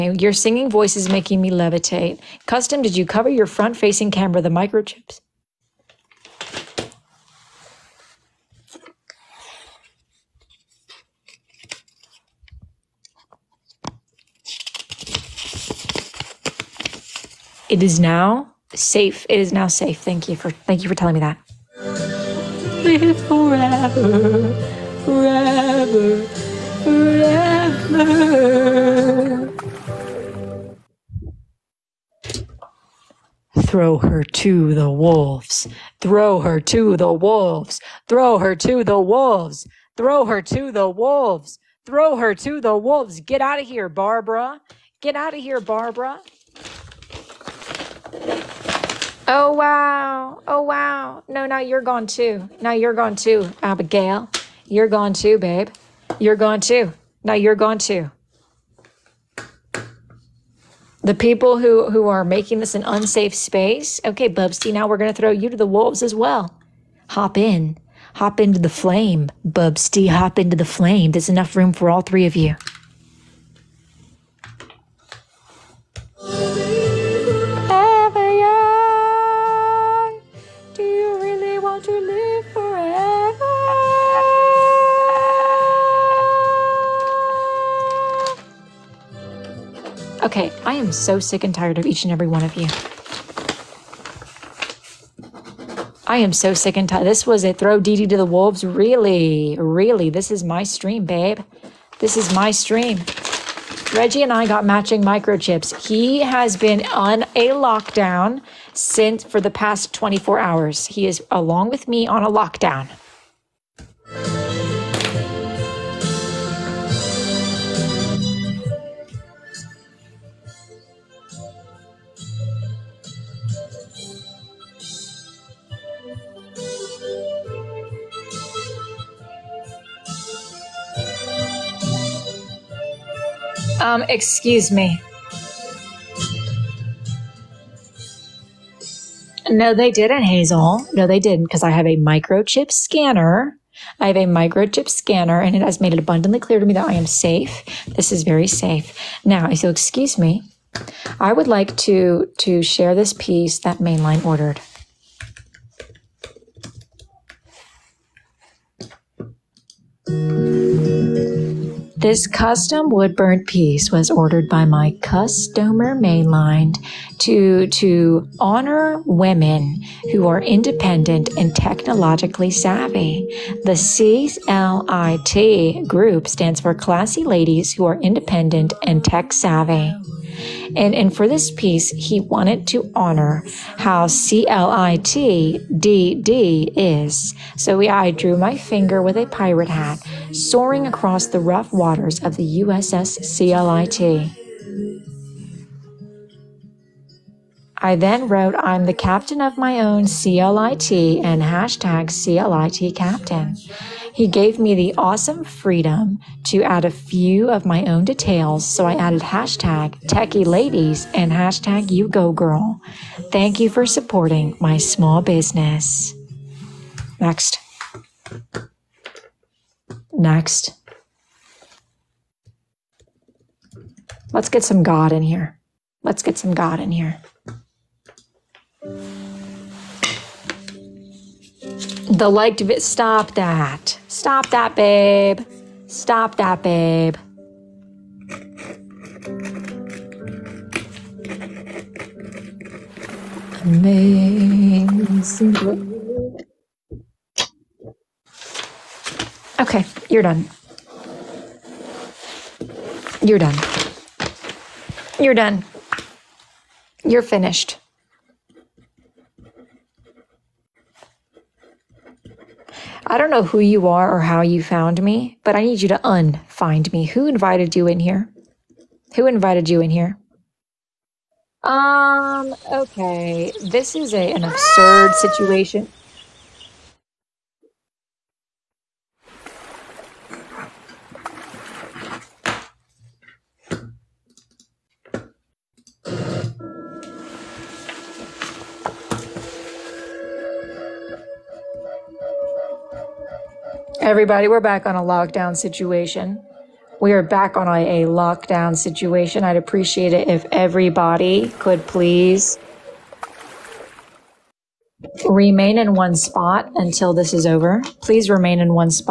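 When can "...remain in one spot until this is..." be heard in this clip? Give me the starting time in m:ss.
5:05.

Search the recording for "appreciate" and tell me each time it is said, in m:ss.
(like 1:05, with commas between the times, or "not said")
4:59.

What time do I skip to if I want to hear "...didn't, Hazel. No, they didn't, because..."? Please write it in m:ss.
2:19.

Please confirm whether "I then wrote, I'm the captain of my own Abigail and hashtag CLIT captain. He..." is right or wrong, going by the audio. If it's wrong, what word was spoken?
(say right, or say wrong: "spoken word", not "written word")
wrong: "CLIT", not "Abigail".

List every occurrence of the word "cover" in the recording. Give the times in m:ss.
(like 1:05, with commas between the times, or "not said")
0:03.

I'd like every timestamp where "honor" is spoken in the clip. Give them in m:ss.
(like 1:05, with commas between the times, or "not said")
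2:48, 3:02.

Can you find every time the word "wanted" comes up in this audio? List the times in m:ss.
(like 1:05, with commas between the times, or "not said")
3:02.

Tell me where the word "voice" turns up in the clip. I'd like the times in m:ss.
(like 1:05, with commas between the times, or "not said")
0:00.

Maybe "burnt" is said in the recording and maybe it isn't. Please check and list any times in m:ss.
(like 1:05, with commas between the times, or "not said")
2:43.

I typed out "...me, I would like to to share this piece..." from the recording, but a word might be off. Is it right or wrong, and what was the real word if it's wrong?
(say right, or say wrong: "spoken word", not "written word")
right.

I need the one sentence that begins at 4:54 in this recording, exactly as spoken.
Everybody, we're back on a lockdown situation.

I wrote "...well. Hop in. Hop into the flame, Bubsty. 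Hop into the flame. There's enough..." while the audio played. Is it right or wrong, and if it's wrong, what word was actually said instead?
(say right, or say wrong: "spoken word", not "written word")
right.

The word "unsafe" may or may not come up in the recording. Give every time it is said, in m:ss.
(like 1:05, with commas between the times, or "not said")
1:02.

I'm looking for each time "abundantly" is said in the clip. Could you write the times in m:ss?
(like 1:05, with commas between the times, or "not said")
2:25.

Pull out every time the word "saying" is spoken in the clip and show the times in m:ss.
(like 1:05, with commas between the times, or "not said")
not said.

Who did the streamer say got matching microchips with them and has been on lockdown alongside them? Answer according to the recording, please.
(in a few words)
Reggie.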